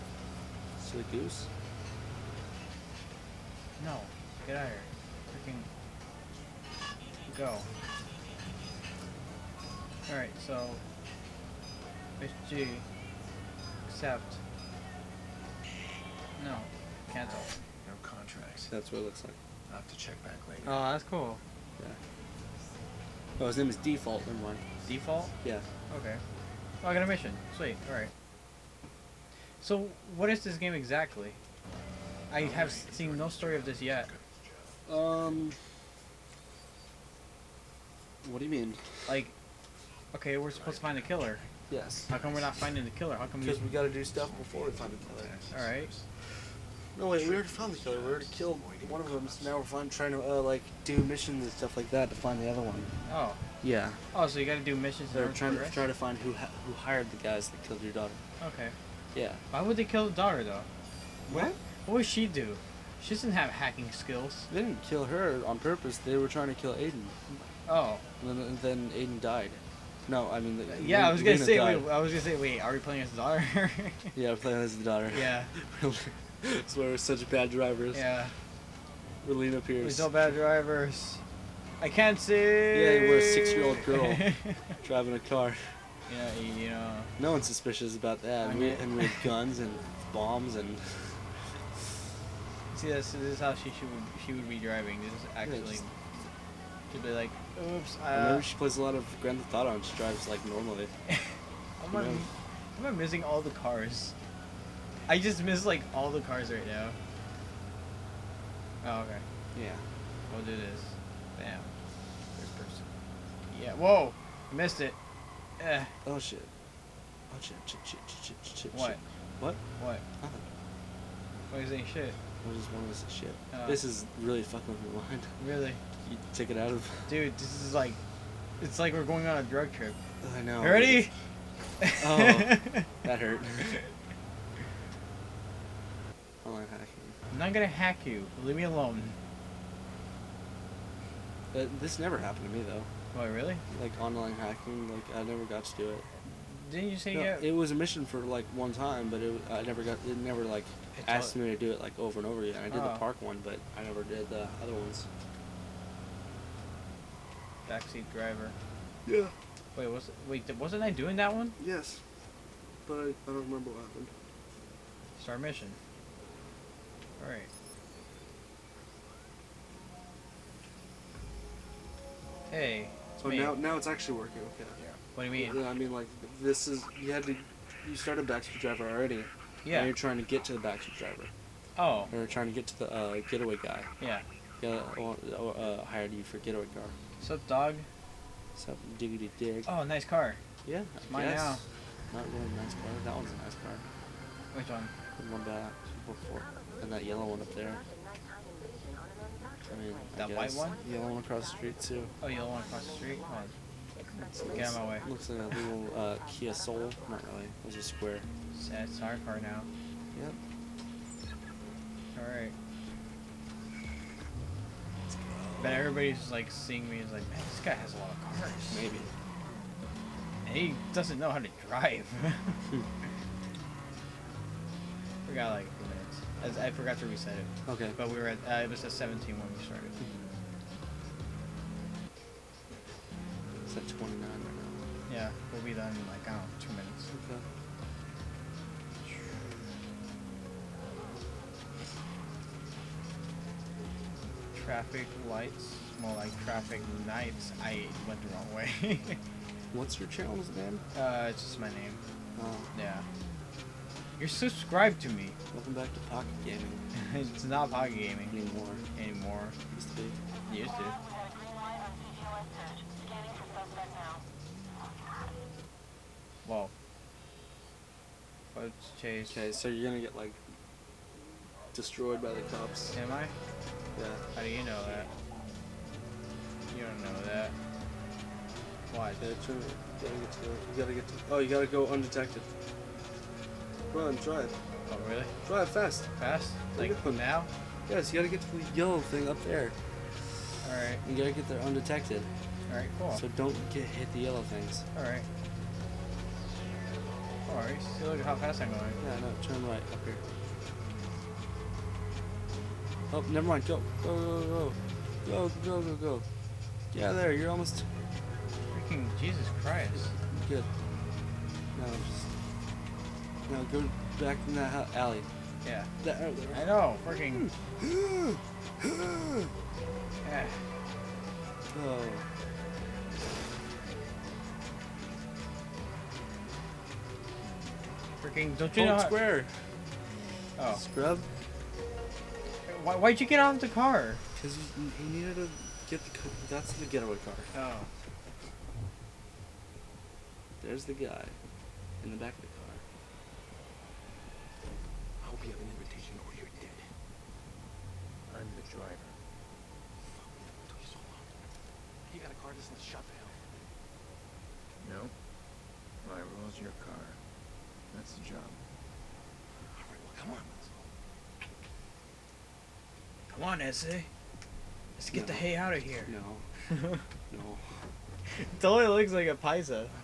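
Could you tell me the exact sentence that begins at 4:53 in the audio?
So don't get hit the yellow things.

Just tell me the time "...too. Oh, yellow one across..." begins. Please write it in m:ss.
3:21.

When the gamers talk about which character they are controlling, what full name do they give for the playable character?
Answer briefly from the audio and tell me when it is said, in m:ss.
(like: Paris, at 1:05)
Lena Pearce, at 1:19.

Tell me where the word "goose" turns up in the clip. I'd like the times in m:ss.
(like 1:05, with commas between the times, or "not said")
0:01.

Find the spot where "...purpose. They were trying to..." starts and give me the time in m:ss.
1:05.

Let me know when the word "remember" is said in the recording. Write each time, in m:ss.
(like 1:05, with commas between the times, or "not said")
1:38, 2:43.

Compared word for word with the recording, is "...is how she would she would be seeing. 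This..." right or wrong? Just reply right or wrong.
wrong.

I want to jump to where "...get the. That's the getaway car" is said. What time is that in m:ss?
5:35.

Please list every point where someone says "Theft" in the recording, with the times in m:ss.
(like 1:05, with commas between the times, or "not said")
1:39.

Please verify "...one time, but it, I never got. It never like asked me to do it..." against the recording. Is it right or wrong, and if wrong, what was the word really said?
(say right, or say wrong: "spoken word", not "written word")
right.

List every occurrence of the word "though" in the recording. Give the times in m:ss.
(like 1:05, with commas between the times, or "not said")
1:00, 2:22.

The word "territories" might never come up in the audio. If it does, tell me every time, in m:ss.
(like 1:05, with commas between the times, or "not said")
not said.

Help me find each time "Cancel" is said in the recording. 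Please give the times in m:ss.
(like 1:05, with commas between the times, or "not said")
0:17.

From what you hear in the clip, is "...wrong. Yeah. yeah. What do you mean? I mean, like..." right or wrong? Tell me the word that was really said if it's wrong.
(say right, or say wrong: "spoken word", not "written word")
wrong: "working", not "wrong".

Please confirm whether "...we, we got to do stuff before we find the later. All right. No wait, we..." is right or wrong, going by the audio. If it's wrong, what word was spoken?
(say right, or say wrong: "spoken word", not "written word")
wrong: "killer", not "later".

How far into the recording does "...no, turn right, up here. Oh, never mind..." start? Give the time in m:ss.
4:59.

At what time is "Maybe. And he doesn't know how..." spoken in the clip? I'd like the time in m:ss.
3:38.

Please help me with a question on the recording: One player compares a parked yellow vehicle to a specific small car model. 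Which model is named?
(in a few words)
Kia Soul.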